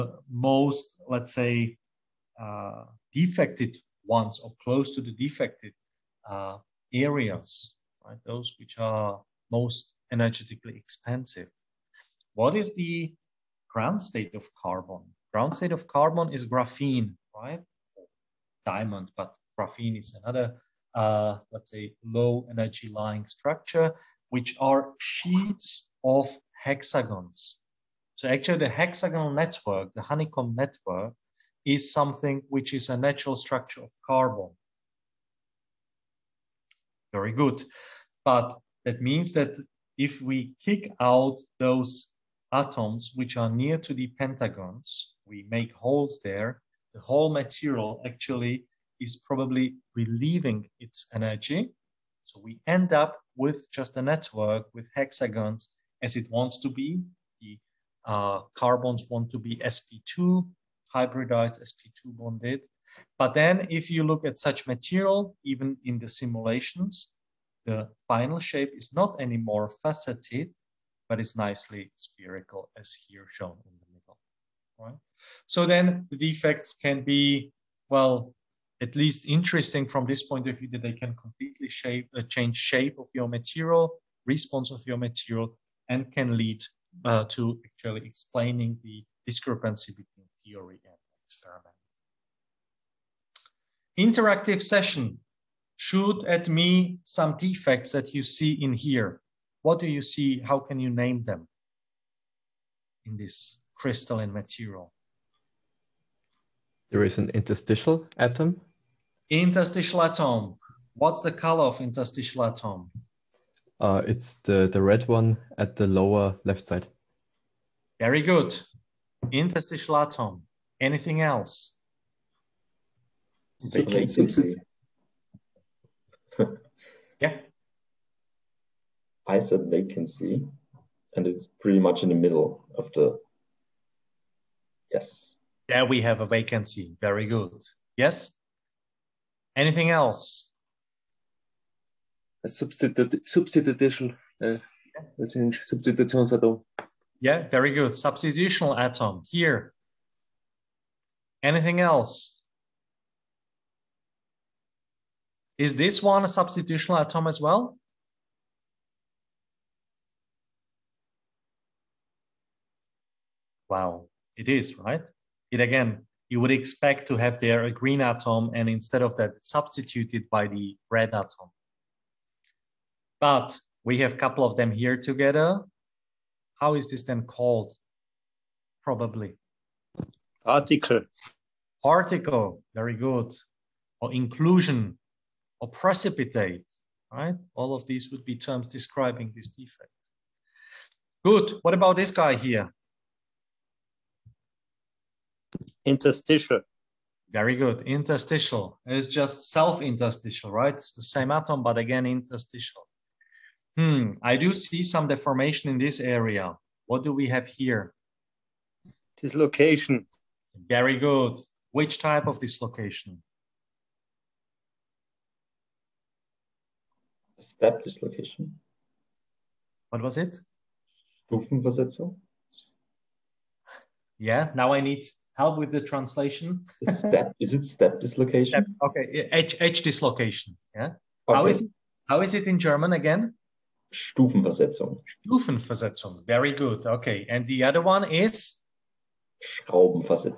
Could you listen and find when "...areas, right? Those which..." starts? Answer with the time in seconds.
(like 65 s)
6 s.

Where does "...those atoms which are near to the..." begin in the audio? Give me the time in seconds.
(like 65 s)
41 s.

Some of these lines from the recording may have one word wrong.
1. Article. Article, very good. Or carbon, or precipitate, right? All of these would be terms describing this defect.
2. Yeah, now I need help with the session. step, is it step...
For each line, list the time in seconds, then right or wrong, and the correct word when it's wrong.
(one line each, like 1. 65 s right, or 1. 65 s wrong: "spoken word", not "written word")
1. 180 s wrong: "inclusion", not "carbon"
2. 224 s wrong: "translation", not "session".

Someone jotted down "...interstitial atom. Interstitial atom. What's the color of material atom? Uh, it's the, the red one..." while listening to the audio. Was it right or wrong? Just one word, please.
wrong.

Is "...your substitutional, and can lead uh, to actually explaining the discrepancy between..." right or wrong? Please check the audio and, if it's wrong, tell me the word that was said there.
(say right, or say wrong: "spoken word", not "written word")
wrong: "material", not "substitutional".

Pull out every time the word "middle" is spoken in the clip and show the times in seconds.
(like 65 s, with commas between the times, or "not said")
73 s, 132 s.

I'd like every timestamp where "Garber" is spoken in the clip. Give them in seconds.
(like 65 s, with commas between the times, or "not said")
not said.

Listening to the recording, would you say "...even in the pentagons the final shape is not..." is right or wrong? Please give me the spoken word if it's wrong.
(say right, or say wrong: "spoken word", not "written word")
wrong: "simulations", not "pentagons".